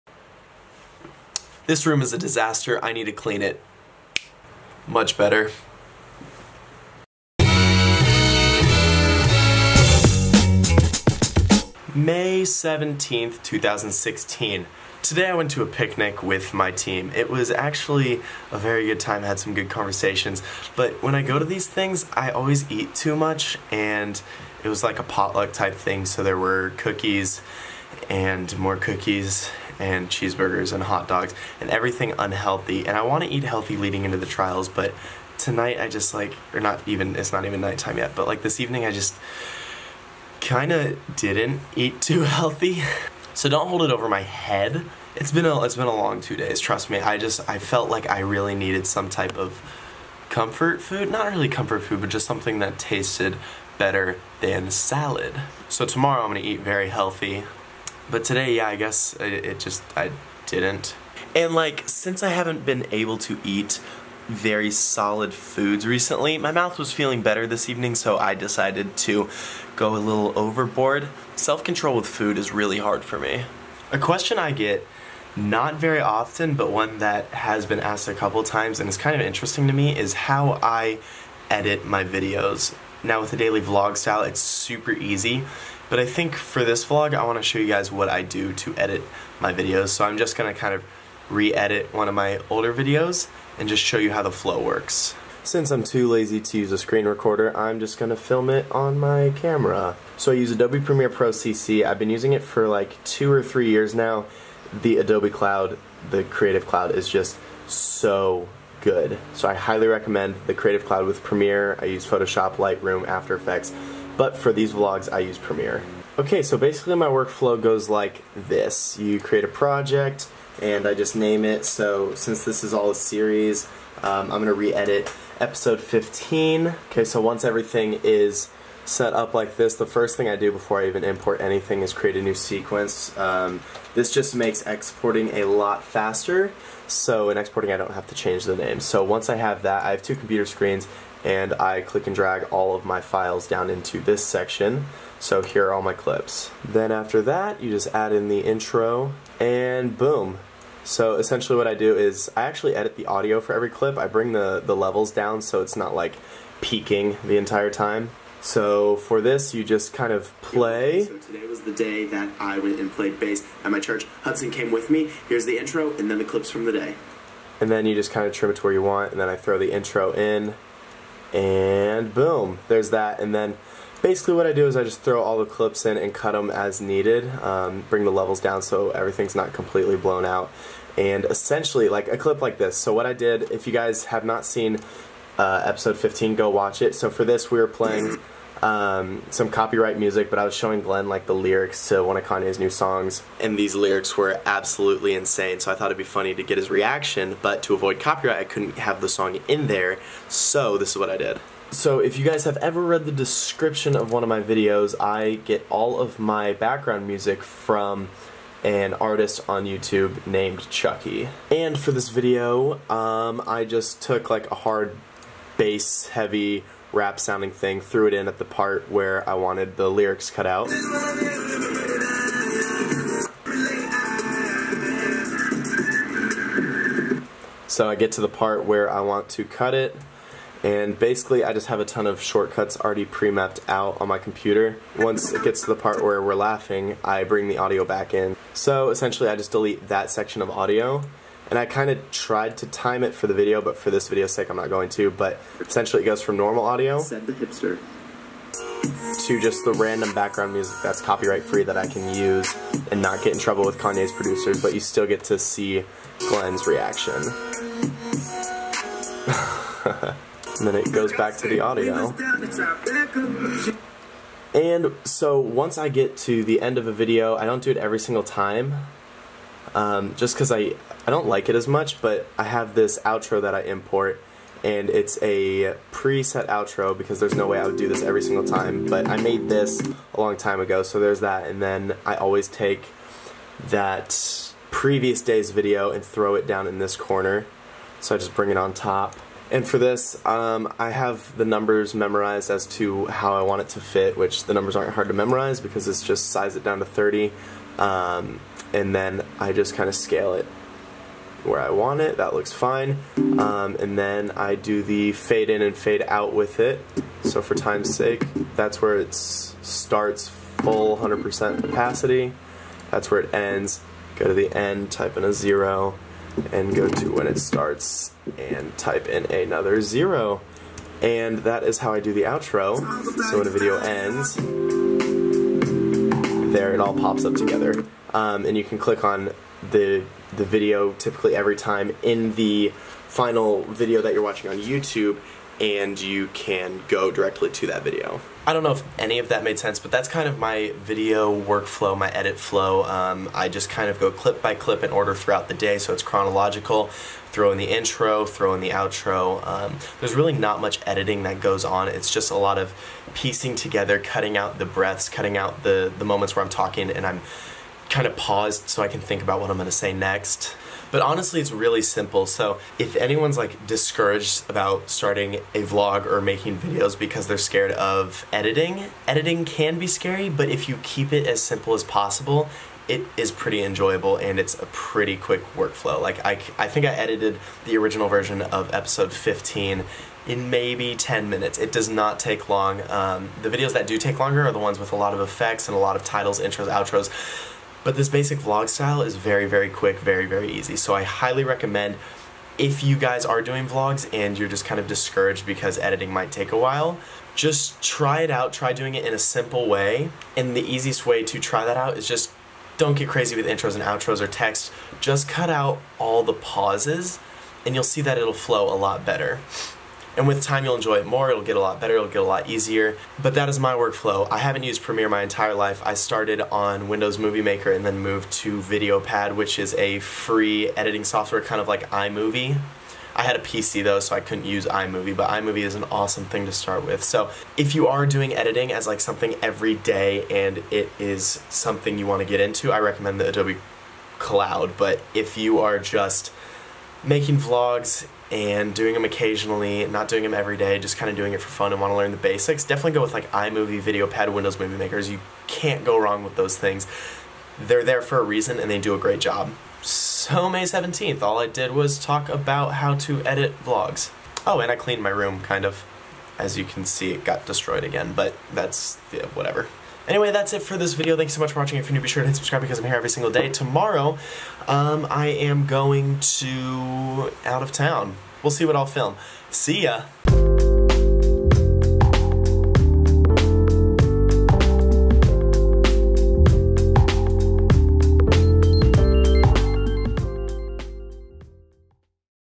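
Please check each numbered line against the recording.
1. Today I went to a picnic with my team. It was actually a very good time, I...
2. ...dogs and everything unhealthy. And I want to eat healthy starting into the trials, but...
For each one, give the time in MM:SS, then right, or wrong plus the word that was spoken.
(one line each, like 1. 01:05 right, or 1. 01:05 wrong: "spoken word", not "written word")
1. 00:15 right
2. 00:31 wrong: "leading", not "starting".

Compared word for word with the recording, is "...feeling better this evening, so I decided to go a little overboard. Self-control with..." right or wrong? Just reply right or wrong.
right.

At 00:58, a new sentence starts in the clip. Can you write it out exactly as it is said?
But today, yeah, I guess it, it just, I didn't.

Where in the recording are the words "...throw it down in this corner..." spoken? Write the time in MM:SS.
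04:46.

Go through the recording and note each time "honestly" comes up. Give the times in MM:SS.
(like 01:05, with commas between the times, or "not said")
06:01.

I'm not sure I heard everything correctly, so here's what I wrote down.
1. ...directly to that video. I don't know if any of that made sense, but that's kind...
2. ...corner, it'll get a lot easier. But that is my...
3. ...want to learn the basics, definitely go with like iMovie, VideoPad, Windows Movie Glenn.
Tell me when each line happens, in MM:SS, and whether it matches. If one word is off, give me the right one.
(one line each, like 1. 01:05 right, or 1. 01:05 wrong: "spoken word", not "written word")
1. 05:37 right
2. 06:51 wrong: "better", not "corner"
3. 07:21 wrong: "Makers", not "Glenn".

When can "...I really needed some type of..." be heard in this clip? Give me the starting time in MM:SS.
00:48.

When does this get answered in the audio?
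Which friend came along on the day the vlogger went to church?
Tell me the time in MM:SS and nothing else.
02:44.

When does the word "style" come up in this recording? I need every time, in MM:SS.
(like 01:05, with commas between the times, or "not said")
01:23, 06:28.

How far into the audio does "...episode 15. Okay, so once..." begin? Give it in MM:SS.
02:05.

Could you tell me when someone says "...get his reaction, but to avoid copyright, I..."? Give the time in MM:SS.
03:16.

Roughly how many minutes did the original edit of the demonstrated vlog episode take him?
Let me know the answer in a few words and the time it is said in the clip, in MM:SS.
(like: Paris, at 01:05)
10 minutes, at 06:20.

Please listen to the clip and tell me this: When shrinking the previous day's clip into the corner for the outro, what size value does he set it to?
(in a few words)
30.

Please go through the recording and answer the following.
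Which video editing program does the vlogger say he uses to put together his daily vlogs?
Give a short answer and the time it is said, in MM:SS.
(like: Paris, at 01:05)
Adobe Premiere Pro CC, at 01:40.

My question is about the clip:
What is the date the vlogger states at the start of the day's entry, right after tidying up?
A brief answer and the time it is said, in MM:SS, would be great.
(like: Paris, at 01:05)
May 17th, 2016, at 00:11.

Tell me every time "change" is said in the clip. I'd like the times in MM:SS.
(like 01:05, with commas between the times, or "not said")
02:18.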